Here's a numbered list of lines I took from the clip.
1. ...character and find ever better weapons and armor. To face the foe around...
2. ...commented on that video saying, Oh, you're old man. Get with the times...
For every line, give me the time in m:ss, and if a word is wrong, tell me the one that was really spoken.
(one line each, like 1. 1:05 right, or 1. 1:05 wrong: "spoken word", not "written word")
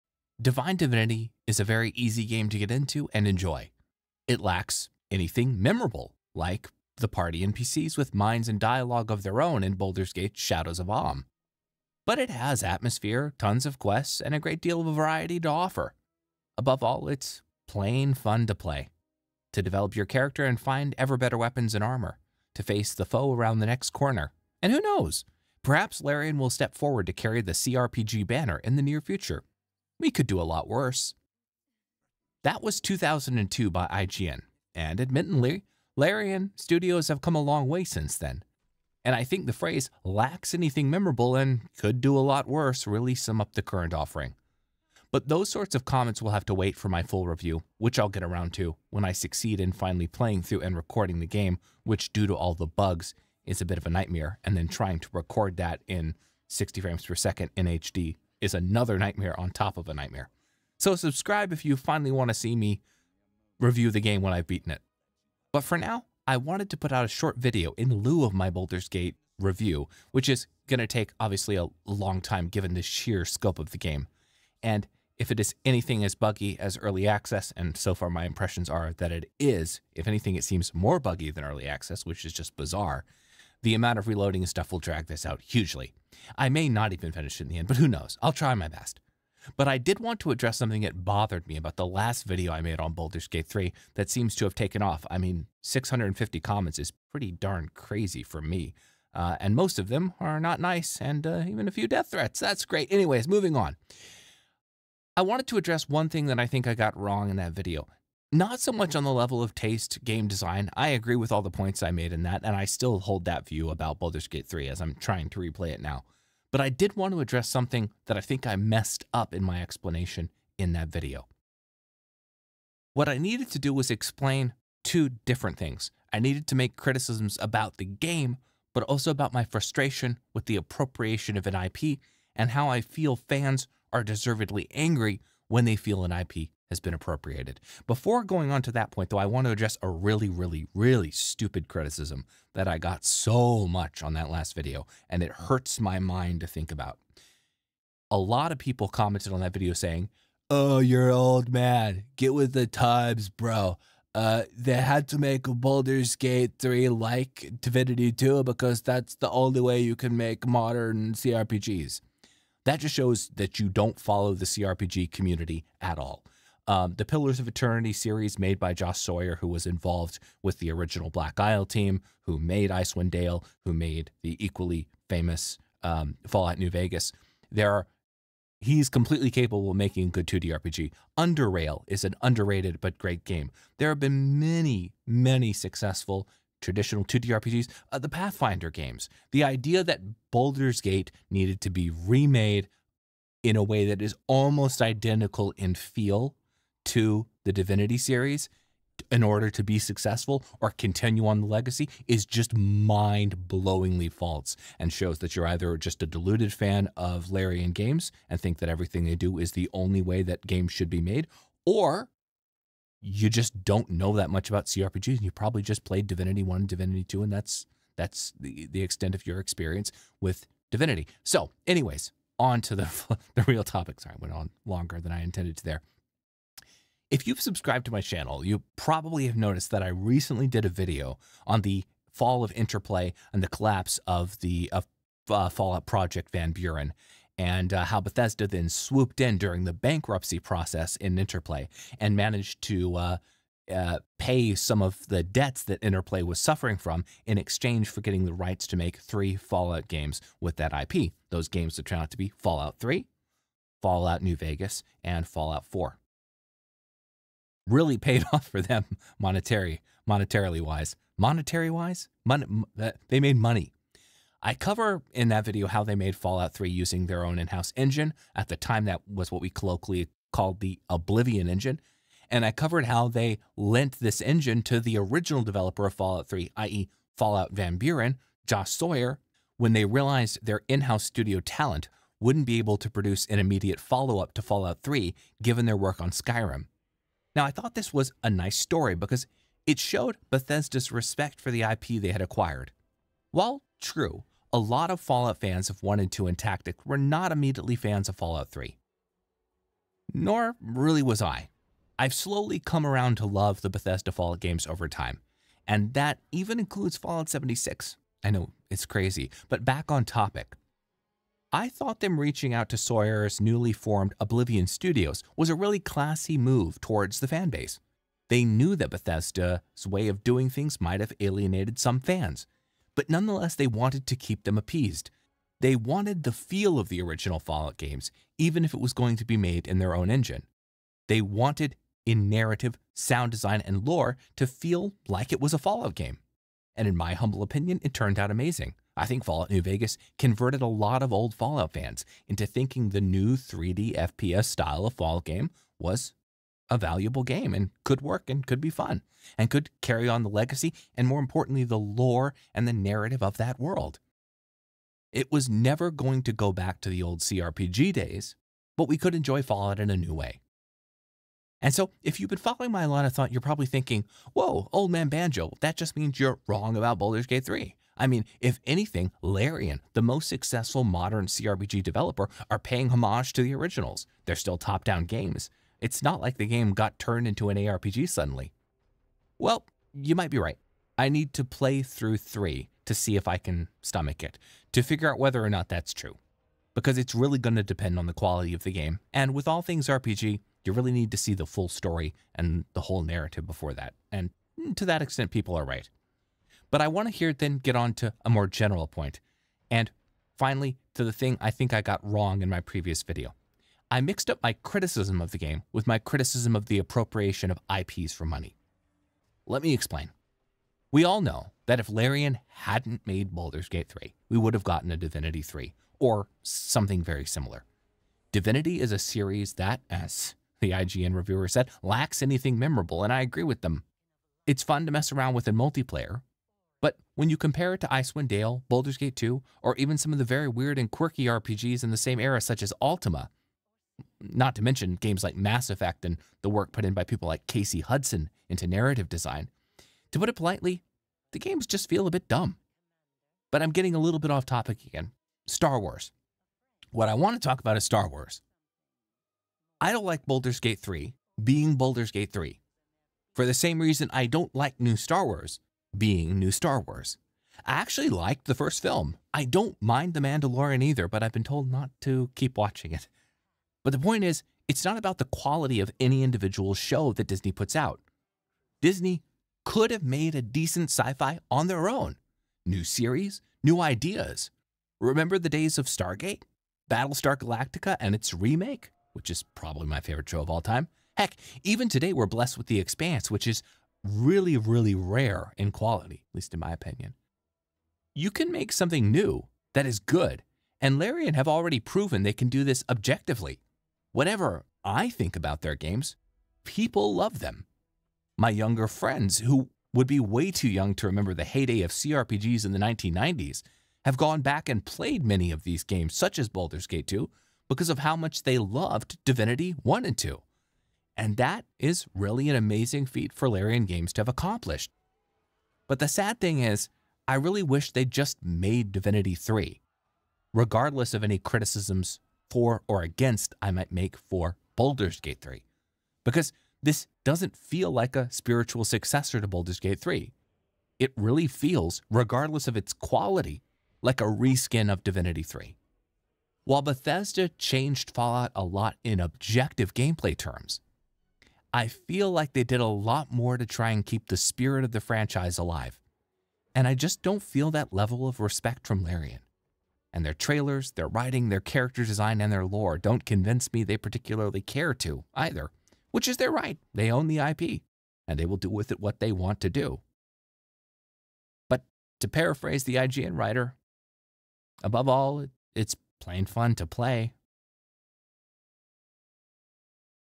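1. 0:20 right
2. 2:28 right.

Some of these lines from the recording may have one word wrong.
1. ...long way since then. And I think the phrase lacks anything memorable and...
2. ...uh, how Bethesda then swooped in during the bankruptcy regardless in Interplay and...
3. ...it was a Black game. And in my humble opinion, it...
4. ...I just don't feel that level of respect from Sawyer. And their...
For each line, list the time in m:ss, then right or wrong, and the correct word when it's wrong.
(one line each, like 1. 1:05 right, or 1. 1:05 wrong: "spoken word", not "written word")
1. 0:37 right
2. 3:57 wrong: "process", not "regardless"
3. 5:35 wrong: "Fallout", not "Black"
4. 9:06 wrong: "Larian", not "Sawyer".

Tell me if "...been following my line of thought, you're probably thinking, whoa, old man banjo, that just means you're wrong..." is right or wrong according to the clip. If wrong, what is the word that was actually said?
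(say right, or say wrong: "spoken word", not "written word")
right.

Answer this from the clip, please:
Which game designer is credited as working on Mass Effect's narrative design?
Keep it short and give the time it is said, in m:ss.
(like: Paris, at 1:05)
Casey Hudson, at 7:17.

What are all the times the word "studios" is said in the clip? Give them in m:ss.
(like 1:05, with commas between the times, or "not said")
0:36, 4:41, 5:14.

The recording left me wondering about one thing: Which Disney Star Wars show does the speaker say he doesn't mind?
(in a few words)
The Mandalorian.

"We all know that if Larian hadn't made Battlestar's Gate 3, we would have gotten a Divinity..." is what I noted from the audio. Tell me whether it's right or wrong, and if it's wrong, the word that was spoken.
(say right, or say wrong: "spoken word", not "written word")
wrong: "Baldur", not "Battlestar".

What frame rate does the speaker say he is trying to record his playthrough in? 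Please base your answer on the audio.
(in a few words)
60 frames per second.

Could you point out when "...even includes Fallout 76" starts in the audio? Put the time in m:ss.
5:06.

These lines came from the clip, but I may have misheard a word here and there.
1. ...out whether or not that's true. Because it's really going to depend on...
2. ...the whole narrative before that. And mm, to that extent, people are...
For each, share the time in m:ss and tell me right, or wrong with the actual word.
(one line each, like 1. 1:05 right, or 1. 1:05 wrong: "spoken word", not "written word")
1. 6:25 right
2. 6:32 right.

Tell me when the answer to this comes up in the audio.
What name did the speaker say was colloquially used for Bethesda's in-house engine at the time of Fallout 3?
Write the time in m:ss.
4:30.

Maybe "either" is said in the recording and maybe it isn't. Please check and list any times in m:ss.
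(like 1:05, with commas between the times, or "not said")
3:25, 7:40, 9:15.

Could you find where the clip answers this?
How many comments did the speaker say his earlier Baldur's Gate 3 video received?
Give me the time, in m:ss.
1:35.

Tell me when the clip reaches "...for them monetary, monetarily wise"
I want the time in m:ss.
4:18.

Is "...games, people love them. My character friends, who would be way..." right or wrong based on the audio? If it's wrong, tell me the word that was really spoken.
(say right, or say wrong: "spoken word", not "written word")
wrong: "younger", not "character".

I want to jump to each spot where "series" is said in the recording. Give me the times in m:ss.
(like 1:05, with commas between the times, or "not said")
2:47, 3:17, 6:58, 7:52.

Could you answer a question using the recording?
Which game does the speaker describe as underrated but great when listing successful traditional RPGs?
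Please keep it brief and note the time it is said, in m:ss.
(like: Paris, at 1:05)
Underrail, at 3:01.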